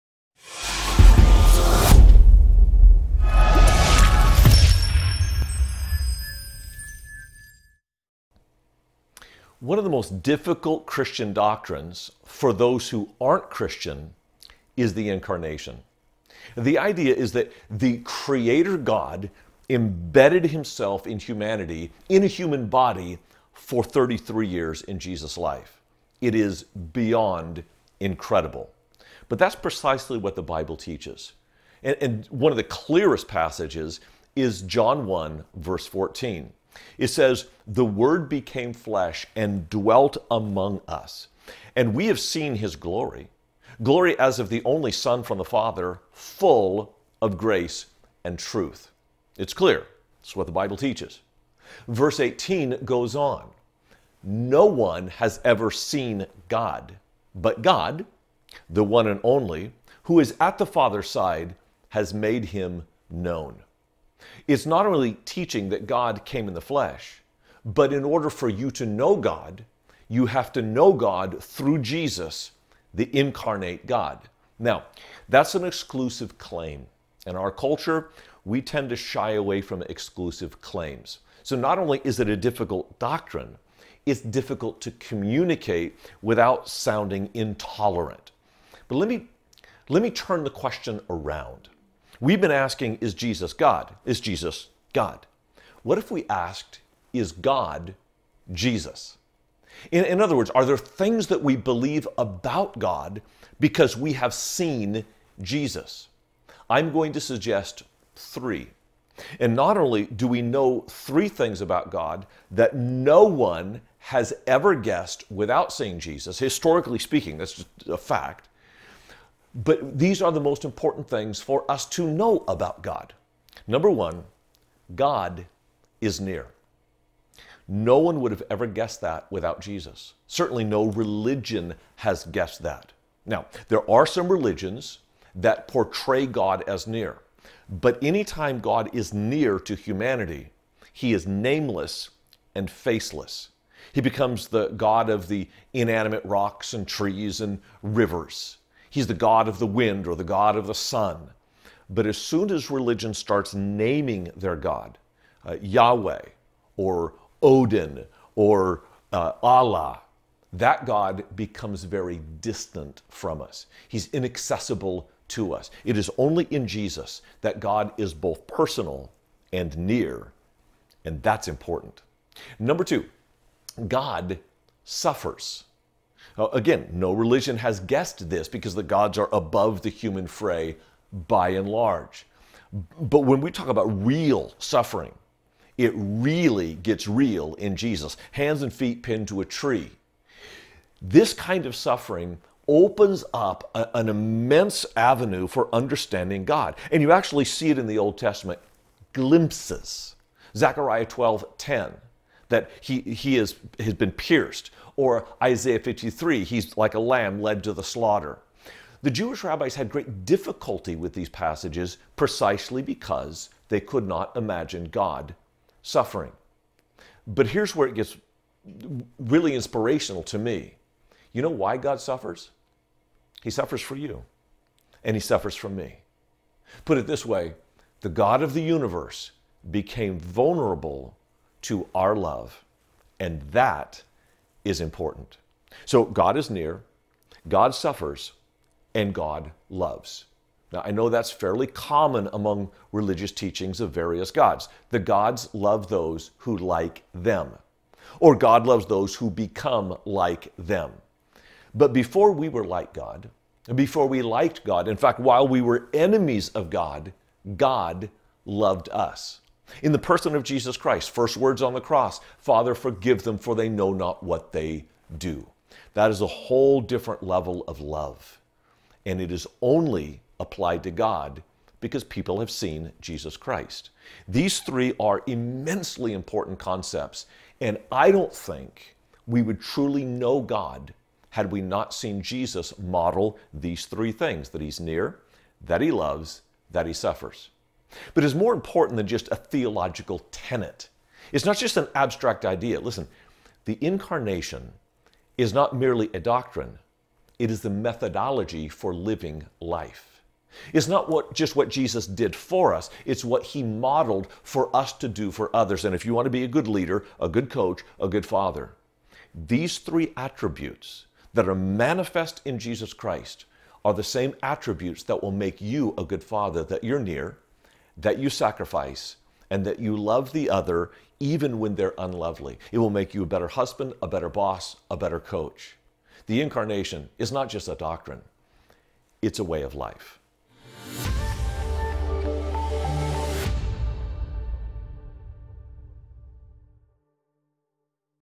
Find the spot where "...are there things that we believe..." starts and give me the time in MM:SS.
01:40.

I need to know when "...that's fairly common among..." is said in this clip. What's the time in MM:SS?
04:01.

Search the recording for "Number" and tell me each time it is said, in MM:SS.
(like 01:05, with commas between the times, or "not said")
02:03, 02:52.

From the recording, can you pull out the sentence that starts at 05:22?
It will make you a better husband, a better boss, a better coach.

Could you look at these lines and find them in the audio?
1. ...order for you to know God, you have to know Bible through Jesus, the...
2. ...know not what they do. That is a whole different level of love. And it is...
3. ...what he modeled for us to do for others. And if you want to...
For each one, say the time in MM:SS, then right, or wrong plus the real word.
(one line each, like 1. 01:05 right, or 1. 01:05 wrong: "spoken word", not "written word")
1. 01:08 wrong: "God", not "Bible"
2. 04:23 right
3. 05:03 right.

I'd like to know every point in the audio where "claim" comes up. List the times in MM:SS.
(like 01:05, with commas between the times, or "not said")
01:16, 01:20.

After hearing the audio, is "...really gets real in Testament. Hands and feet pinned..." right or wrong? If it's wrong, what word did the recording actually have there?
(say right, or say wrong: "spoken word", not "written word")
wrong: "Jesus", not "Testament".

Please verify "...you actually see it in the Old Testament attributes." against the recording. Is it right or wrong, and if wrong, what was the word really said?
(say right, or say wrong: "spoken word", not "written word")
wrong: "glimpses", not "attributes".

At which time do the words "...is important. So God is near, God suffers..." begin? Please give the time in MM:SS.
03:54.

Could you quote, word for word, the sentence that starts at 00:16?
The idea is that the Creator God embedded himself in humanity, in a human body, for 33 years in Jesus' life.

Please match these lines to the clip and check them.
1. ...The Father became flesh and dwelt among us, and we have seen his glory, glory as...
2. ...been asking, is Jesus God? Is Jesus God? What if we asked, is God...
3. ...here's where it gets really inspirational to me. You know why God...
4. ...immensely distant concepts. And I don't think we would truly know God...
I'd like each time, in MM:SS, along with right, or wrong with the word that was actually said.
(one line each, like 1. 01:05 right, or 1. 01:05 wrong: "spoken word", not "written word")
1. 00:37 wrong: "Word", not "Father"
2. 01:32 right
3. 03:37 right
4. 04:35 wrong: "important", not "distant".